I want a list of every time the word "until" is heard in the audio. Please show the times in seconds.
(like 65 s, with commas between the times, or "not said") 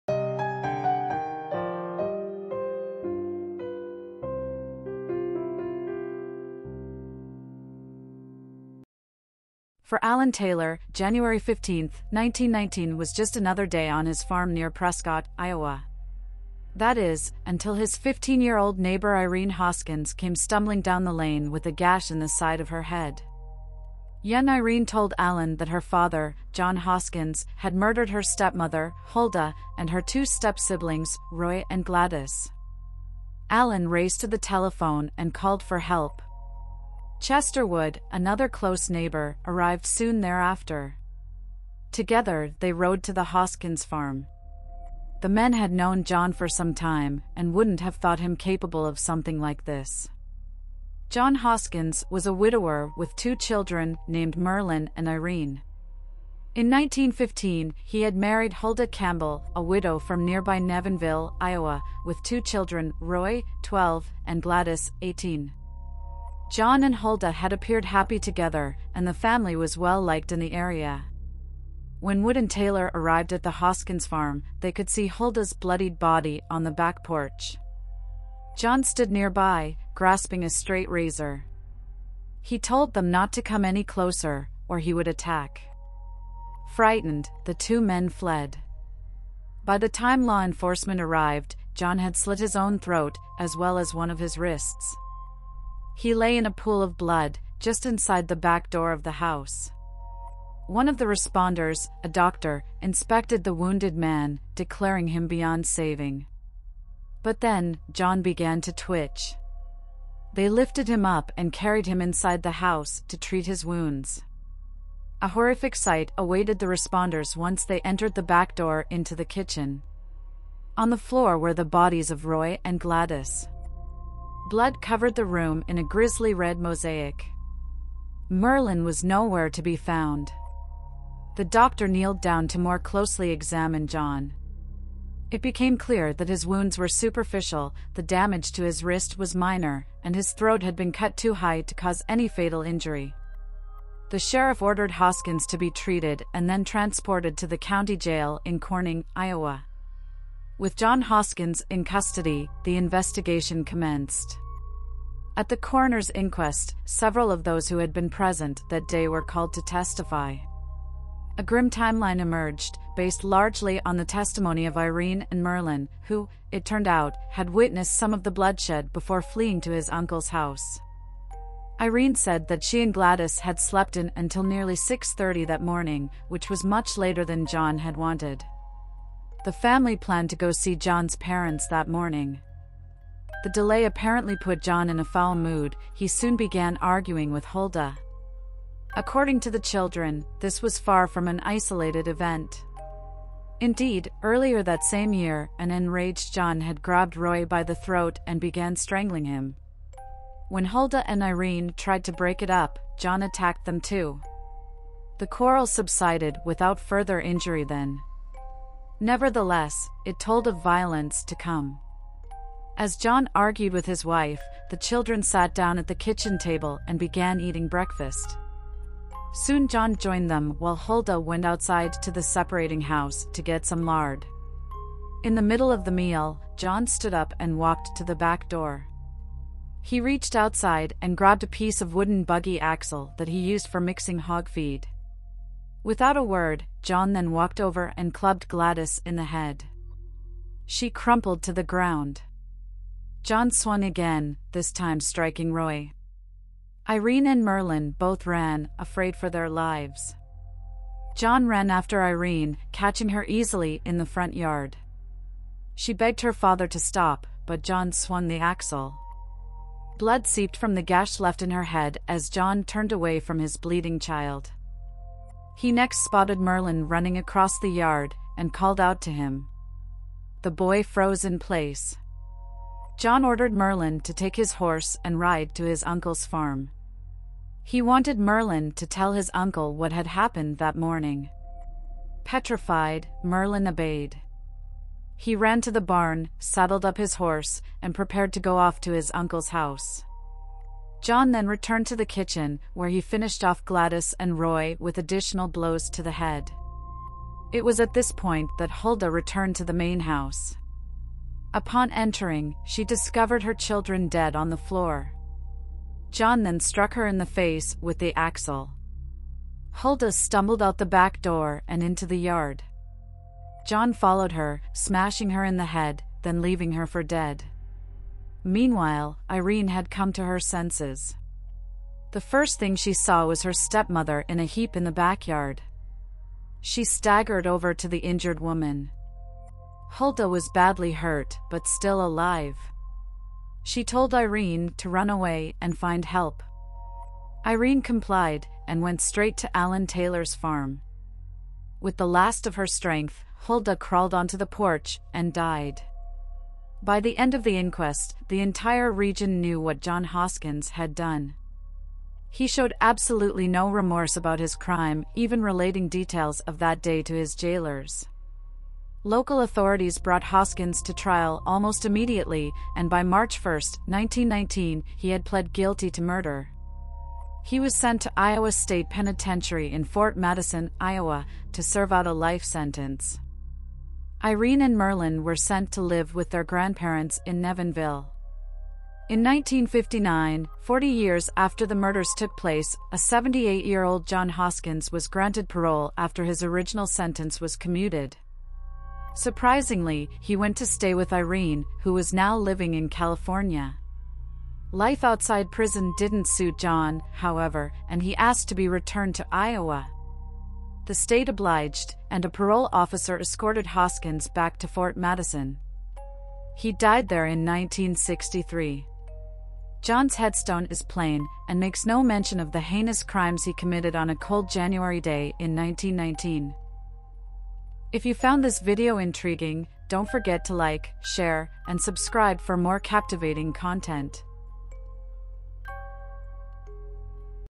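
17 s, 174 s.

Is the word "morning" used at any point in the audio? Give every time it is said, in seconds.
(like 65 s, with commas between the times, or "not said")
175 s, 181 s, 280 s.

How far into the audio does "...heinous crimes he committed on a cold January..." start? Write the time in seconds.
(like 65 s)
412 s.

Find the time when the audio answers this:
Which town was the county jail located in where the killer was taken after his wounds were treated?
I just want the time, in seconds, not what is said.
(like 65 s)
148 s.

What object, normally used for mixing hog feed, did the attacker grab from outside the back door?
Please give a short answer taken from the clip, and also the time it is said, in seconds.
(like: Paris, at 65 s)
A piece of wooden buggy axle, at 231 s.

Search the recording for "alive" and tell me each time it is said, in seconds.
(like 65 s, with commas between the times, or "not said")
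332 s.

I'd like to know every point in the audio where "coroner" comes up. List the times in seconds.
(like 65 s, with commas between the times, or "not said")
155 s.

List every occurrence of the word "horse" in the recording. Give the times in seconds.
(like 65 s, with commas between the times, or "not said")
274 s, 287 s.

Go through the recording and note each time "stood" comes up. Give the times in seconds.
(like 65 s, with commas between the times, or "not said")
78 s, 226 s.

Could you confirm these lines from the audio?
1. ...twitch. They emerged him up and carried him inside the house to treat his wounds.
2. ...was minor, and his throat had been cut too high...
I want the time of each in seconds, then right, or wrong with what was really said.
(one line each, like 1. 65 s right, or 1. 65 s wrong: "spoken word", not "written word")
1. 108 s wrong: "lifted", not "emerged"
2. 139 s right.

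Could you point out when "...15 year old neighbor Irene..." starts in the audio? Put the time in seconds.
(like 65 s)
17 s.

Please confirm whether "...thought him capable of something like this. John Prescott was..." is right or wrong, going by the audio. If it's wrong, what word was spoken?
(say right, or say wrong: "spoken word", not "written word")
wrong: "Hoskins", not "Prescott".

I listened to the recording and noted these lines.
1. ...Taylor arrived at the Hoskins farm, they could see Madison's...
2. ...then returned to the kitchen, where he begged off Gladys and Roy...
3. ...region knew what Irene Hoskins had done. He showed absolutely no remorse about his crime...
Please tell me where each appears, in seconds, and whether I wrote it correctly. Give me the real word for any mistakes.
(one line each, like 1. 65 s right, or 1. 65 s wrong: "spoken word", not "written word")
1. 72 s wrong: "Hulda", not "Madison"
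2. 291 s wrong: "finished", not "begged"
3. 348 s wrong: "John", not "Irene".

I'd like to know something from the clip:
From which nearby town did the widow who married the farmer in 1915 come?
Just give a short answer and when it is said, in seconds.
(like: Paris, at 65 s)
Nevinville, Iowa, at 60 s.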